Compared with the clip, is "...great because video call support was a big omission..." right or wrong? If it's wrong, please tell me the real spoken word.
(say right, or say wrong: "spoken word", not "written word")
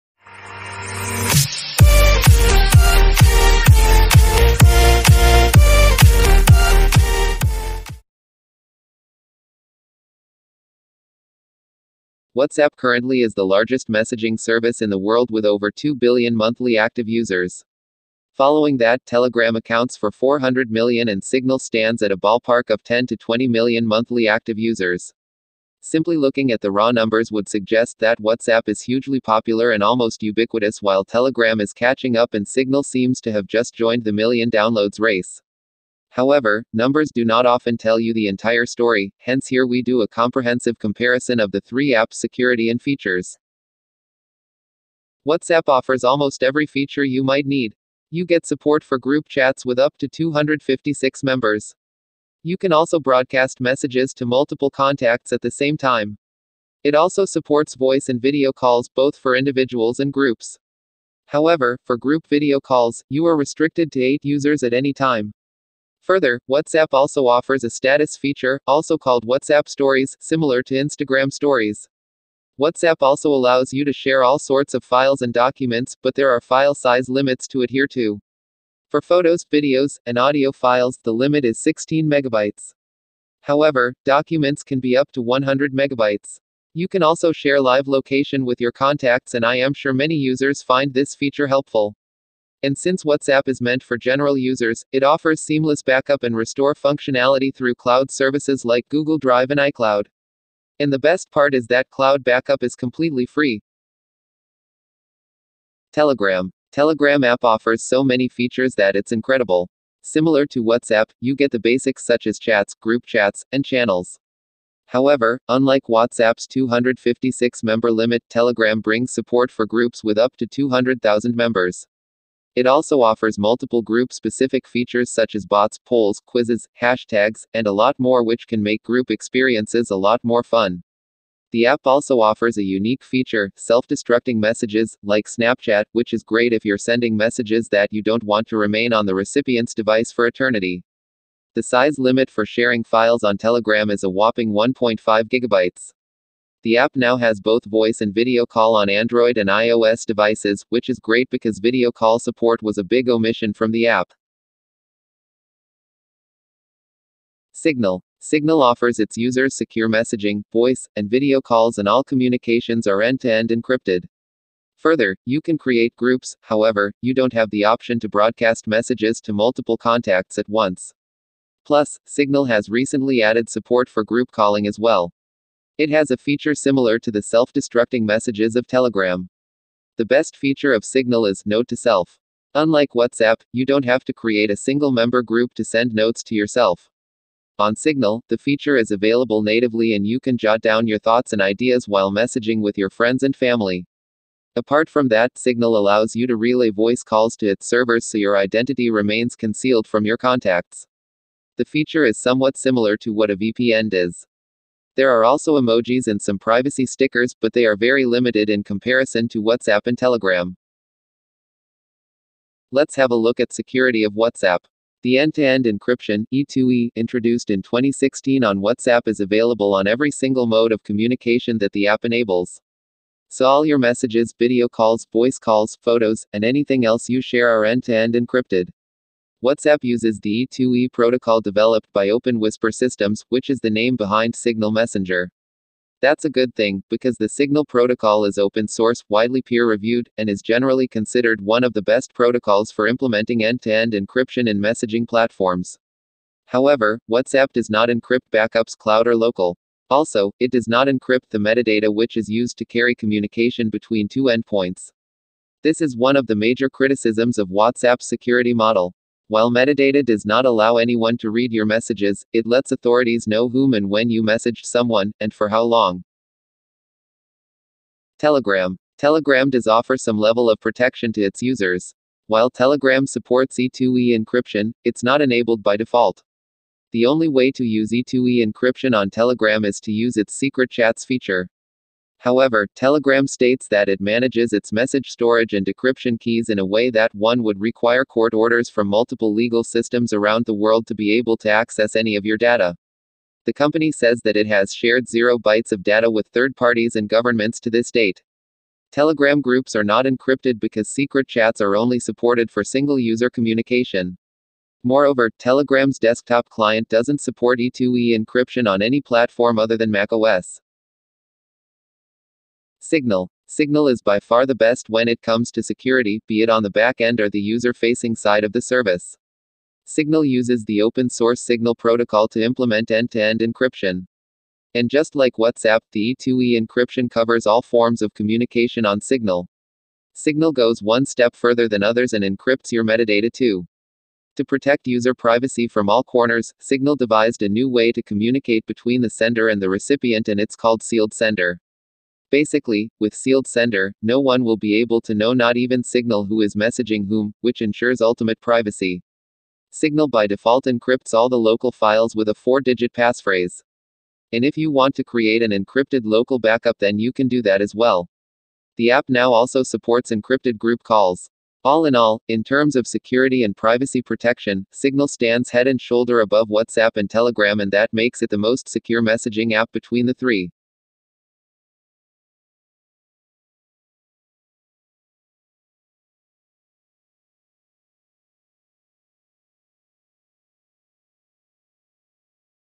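right.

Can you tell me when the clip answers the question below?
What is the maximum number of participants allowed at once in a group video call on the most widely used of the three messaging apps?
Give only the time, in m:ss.
1:04.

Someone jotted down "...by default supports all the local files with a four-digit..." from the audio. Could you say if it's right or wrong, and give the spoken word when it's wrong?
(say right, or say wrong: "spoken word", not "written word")
wrong: "encrypts", not "supports".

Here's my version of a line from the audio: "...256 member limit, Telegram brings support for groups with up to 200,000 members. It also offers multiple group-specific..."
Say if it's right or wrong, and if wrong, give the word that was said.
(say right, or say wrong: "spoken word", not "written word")
right.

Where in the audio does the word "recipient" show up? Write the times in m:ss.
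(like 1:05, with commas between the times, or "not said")
2:19, 5:39.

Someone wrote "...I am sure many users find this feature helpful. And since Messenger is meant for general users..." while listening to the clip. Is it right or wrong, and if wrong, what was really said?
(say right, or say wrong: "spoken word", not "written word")
wrong: "WhatsApp", not "Messenger".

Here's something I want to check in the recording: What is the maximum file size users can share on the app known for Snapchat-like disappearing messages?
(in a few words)
1.5 gigabytes.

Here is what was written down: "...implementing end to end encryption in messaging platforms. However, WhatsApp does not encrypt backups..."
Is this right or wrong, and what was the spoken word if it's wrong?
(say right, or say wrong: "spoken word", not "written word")
right.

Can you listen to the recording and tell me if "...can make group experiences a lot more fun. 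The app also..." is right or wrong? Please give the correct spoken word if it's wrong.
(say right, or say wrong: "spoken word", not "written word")
right.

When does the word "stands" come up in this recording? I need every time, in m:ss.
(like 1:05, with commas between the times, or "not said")
0:21, 6:05.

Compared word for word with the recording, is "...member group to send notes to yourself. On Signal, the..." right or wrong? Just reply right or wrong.
right.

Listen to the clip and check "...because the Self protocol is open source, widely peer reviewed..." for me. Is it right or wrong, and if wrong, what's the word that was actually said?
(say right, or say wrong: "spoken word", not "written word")
wrong: "Signal", not "Self".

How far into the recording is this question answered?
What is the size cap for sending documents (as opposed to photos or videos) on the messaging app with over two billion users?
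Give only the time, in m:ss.
1:25.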